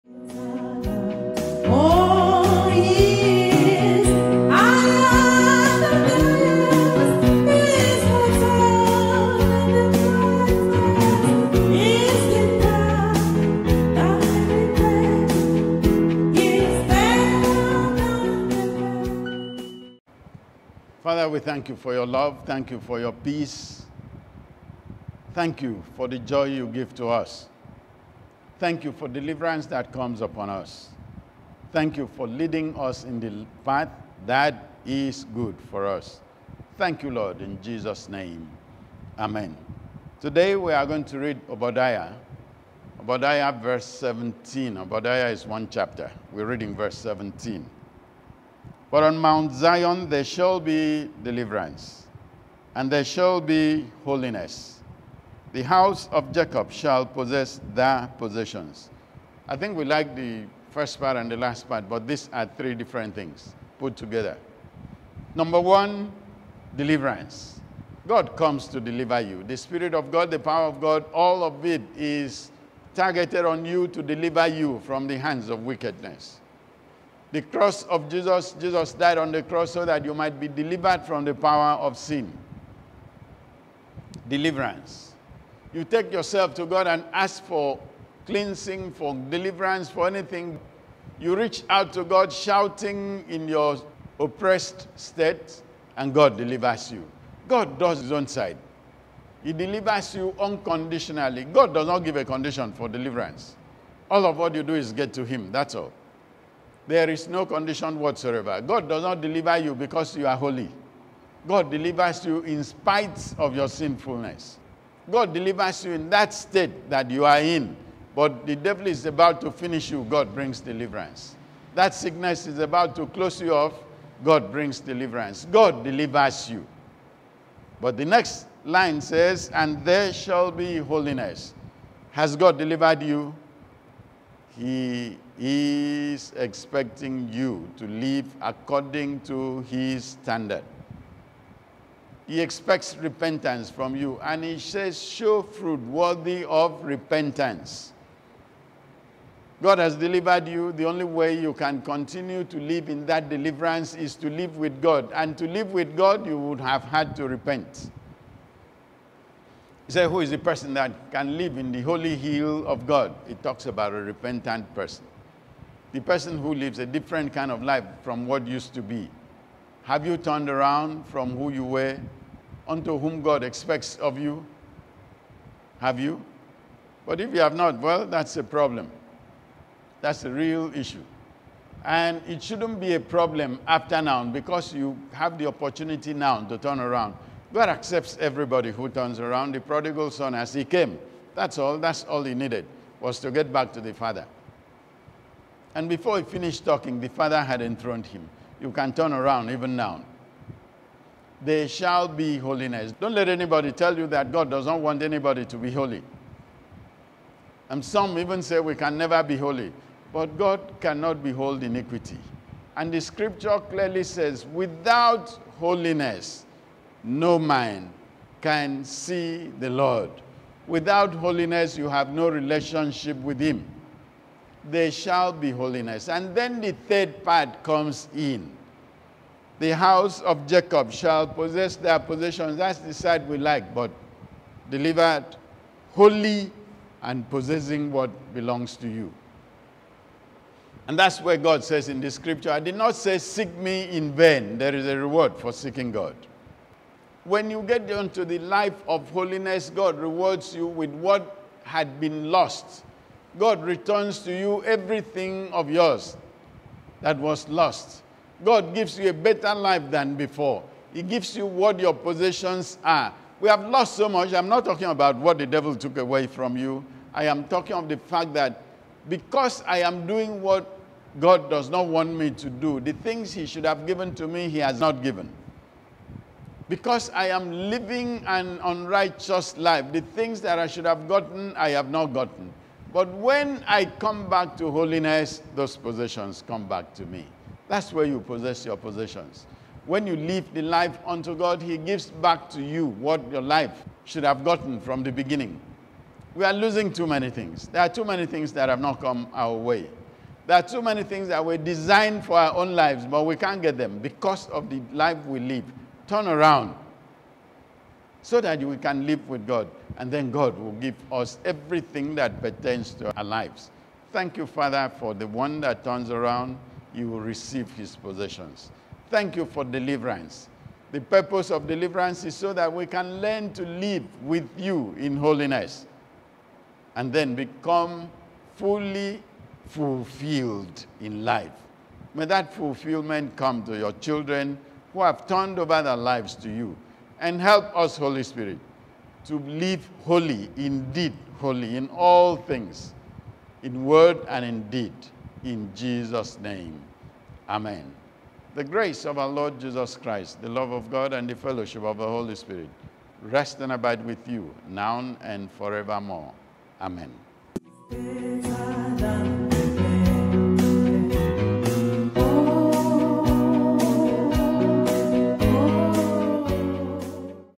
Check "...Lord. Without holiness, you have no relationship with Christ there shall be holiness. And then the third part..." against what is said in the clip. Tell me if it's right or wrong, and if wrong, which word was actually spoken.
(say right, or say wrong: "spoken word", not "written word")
wrong: "Him", not "Christ".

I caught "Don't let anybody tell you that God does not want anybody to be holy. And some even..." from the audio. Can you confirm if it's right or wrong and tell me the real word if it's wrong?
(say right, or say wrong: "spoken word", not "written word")
right.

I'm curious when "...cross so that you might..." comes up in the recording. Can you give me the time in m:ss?
1:19.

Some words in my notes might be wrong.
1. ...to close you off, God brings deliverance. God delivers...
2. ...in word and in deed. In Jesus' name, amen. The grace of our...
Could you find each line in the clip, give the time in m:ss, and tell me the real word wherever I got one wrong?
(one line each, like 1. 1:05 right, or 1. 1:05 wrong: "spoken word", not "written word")
1. 2:02 right
2. 5:43 right.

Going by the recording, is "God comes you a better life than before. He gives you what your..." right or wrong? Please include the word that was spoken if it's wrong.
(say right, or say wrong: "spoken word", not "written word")
wrong: "gives", not "comes".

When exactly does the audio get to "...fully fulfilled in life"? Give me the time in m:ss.
5:28.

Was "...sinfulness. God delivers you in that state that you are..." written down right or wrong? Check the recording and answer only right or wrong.
right.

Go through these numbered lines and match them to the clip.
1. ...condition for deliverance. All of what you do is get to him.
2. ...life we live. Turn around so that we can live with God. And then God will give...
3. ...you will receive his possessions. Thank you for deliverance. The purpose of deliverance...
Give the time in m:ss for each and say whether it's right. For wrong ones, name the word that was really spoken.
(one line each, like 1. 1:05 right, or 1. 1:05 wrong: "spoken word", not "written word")
1. 1:42 right
2. 5:04 right
3. 5:16 right.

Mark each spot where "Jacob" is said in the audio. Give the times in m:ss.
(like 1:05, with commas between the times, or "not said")
0:56, 3:50.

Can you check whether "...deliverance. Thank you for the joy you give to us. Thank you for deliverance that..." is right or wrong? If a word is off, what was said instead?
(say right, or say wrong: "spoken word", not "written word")
wrong: "peace", not "deliverance".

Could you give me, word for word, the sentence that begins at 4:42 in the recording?
But when I come back to holiness, those possessions come back to me.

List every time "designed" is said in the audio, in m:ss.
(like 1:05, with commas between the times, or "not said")
5:01.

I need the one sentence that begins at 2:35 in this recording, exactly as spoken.
And to live with God, you would have had to repent.